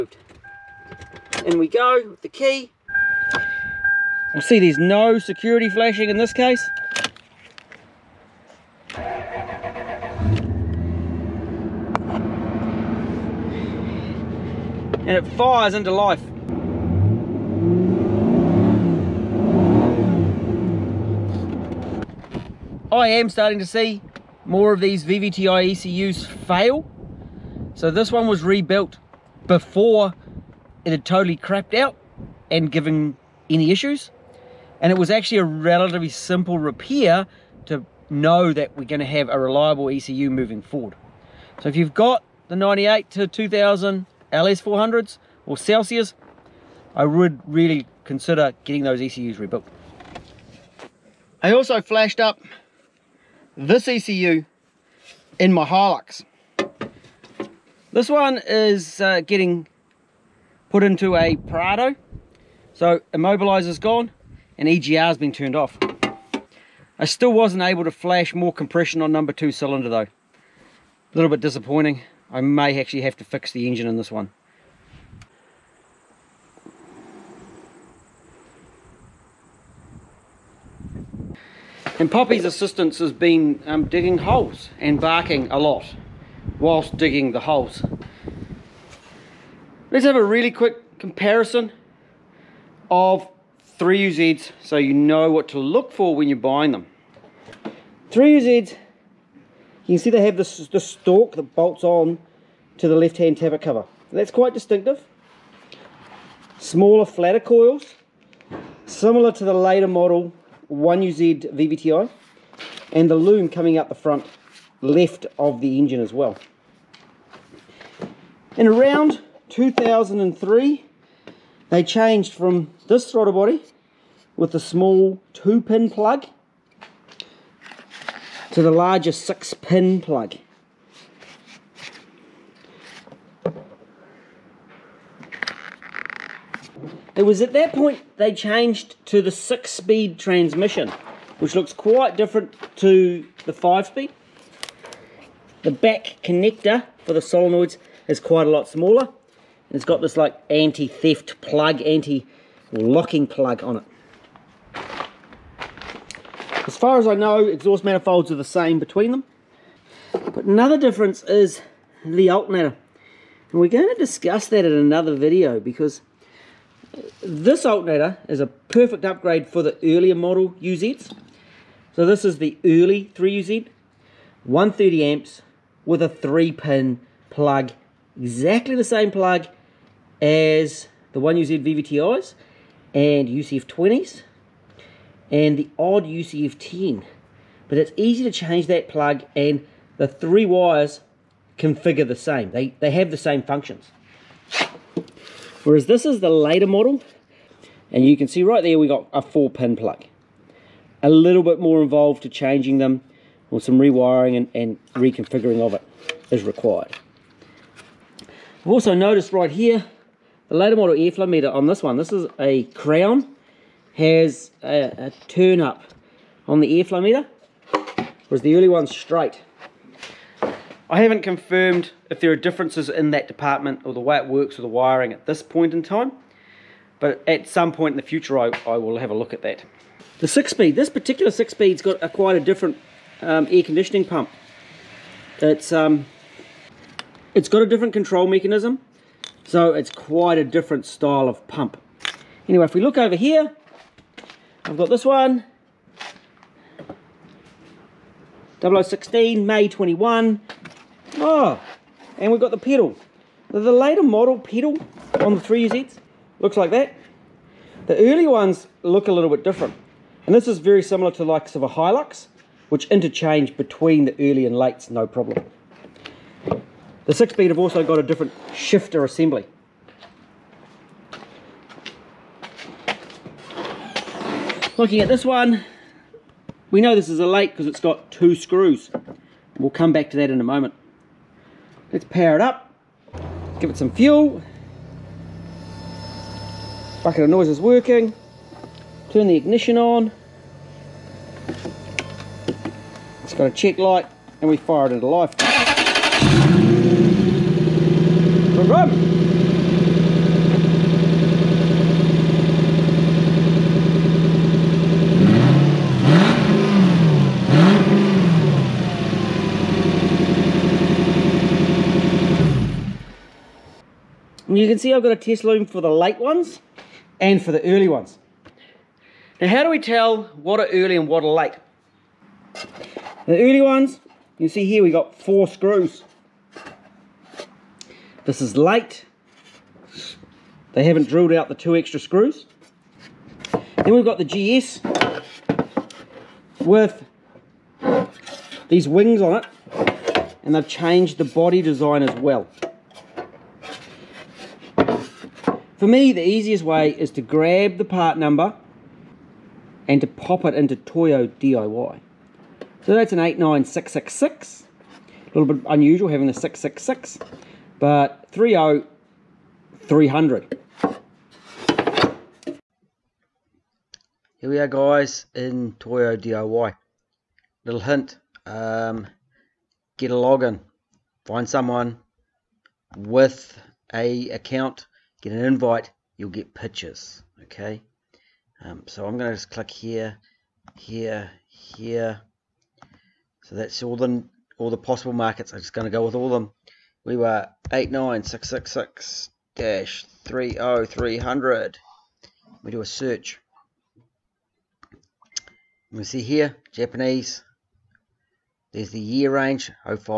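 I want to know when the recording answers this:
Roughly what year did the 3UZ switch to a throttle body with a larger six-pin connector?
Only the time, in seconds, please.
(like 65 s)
119 s.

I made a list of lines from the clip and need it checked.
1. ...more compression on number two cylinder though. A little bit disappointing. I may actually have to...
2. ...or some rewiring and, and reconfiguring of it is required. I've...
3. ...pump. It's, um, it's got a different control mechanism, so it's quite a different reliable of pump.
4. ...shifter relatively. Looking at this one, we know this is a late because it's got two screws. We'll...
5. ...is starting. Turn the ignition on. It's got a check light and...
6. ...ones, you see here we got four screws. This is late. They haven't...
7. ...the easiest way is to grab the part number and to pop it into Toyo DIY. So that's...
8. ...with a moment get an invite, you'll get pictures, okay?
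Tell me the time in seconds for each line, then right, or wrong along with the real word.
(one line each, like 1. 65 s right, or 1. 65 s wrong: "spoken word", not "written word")
1. 68 s right
2. 203 s right
3. 234 s wrong: "style", not "reliable"
4. 268 s wrong: "assembly", not "relatively"
5. 287 s wrong: "working", not "starting"
6. 323 s right
7. 346 s right
8. 372 s wrong: "account", not "moment".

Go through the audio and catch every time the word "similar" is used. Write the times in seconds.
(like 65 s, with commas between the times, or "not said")
108 s, 260 s.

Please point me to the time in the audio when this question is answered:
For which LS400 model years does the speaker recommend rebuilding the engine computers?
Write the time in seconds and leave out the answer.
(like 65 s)
42 s.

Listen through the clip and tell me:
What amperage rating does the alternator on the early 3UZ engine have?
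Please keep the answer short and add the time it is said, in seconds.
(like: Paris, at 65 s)
130 amps, at 174 s.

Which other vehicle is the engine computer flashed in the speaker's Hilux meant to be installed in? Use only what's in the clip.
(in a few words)
Prado.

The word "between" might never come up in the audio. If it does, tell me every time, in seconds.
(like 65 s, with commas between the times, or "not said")
158 s, 263 s.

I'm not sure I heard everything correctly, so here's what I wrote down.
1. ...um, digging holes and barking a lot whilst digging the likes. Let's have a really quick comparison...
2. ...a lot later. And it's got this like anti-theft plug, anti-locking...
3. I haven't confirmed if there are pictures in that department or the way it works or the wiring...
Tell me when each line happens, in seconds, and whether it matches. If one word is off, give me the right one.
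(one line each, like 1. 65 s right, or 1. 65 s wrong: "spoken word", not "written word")
1. 83 s wrong: "holes", not "likes"
2. 148 s wrong: "smaller", not "later"
3. 220 s wrong: "differences", not "pictures".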